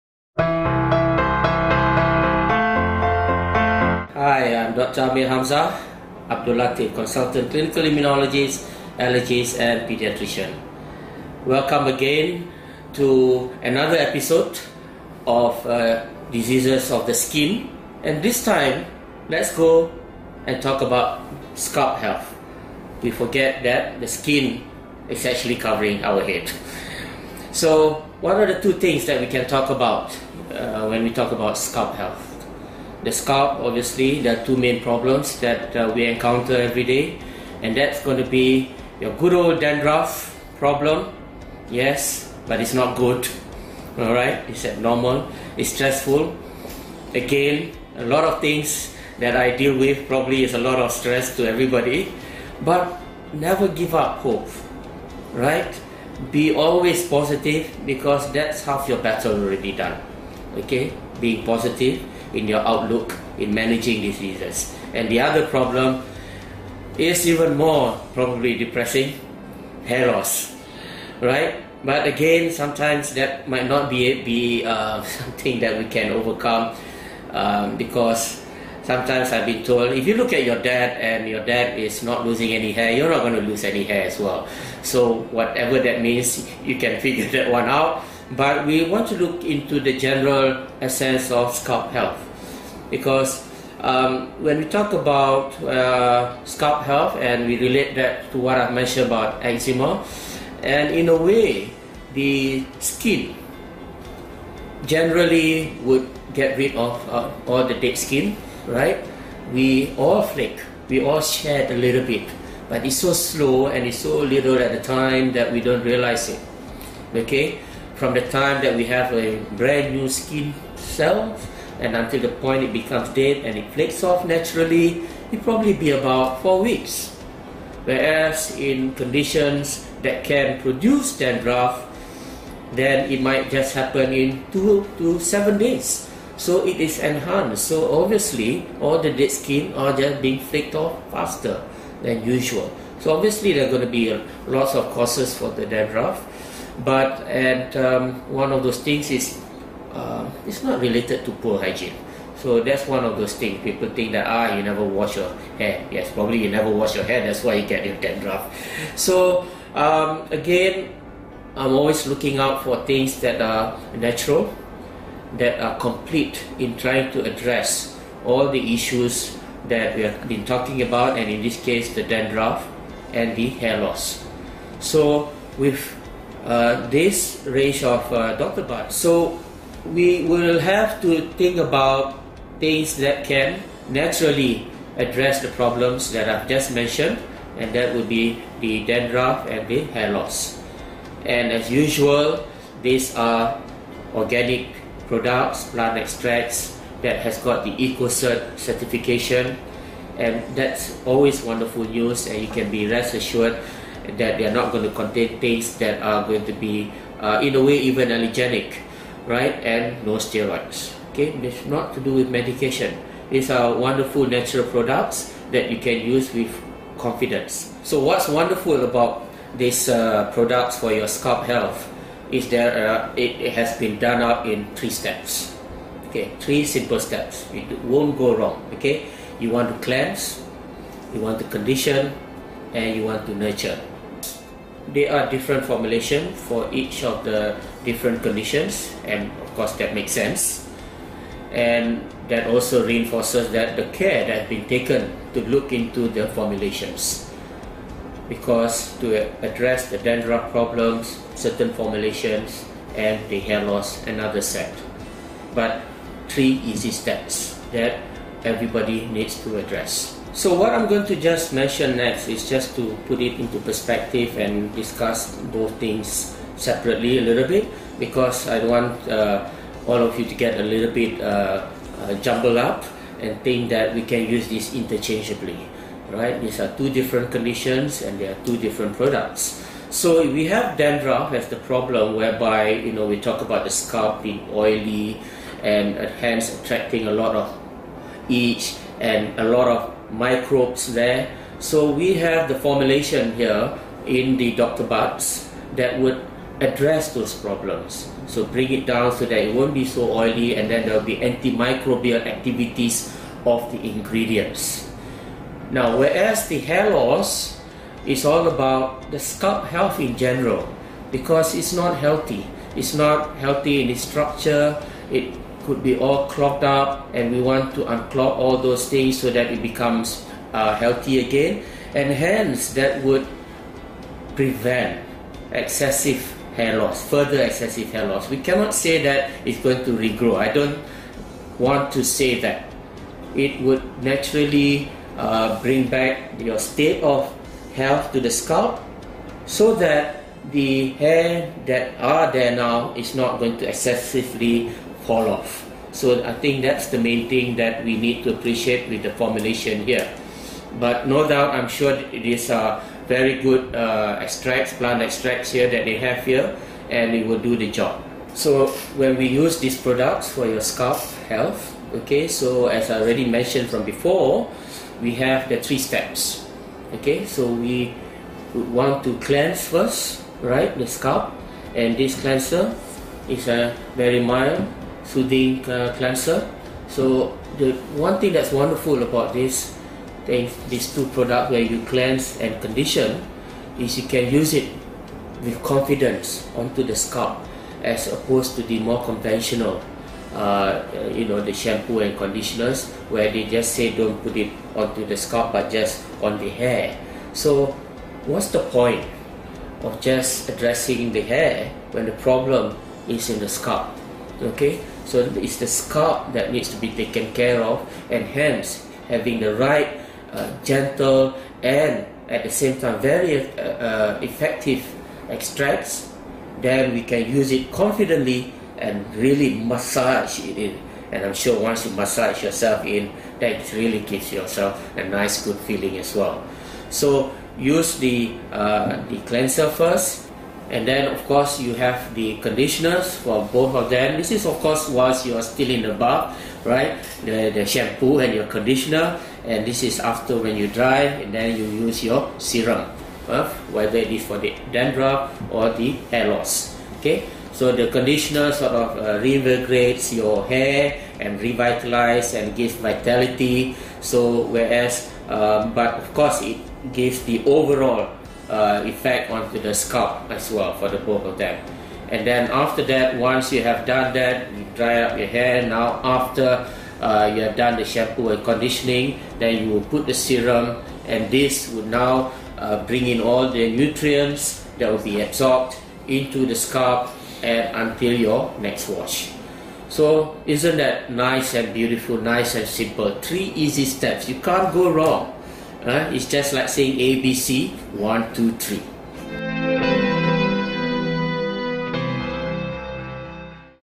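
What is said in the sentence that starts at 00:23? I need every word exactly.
We forget that the skin is actually covering our head.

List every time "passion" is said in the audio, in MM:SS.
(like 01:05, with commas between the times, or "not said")
not said.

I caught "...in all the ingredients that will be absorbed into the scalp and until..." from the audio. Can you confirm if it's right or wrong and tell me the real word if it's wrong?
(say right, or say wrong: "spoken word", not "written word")
wrong: "nutrients", not "ingredients".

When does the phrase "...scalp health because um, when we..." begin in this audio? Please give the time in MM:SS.
01:31.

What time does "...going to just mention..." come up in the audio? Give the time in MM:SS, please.
04:20.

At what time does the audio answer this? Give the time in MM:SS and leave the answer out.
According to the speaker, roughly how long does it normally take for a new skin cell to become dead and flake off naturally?
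02:06.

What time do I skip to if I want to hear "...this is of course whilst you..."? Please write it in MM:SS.
07:14.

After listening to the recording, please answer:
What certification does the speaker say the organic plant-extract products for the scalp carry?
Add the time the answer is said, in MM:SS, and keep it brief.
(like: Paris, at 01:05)
EcoCert, at 03:17.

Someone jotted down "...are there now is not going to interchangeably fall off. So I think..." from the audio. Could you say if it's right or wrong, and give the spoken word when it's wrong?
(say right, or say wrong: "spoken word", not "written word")
wrong: "excessively", not "interchangeably".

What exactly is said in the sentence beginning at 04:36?
These are two different conditions and they are two different products.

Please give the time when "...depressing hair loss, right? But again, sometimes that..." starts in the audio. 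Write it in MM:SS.
01:08.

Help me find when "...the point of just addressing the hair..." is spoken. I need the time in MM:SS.
06:38.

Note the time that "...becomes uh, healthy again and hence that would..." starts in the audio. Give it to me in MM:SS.
05:19.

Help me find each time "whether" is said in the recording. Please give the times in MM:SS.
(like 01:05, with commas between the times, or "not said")
07:23.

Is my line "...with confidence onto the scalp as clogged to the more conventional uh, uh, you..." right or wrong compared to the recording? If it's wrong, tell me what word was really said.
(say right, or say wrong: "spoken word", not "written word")
wrong: "opposed", not "clogged".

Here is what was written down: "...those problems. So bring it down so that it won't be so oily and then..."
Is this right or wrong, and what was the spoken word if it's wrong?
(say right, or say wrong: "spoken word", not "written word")
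right.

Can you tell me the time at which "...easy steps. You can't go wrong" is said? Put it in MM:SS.
08:03.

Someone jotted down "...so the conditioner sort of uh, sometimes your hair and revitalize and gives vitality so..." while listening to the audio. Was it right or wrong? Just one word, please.
wrong.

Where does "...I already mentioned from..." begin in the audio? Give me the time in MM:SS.
06:02.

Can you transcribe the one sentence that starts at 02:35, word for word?
Yes, probably you never wash your hair.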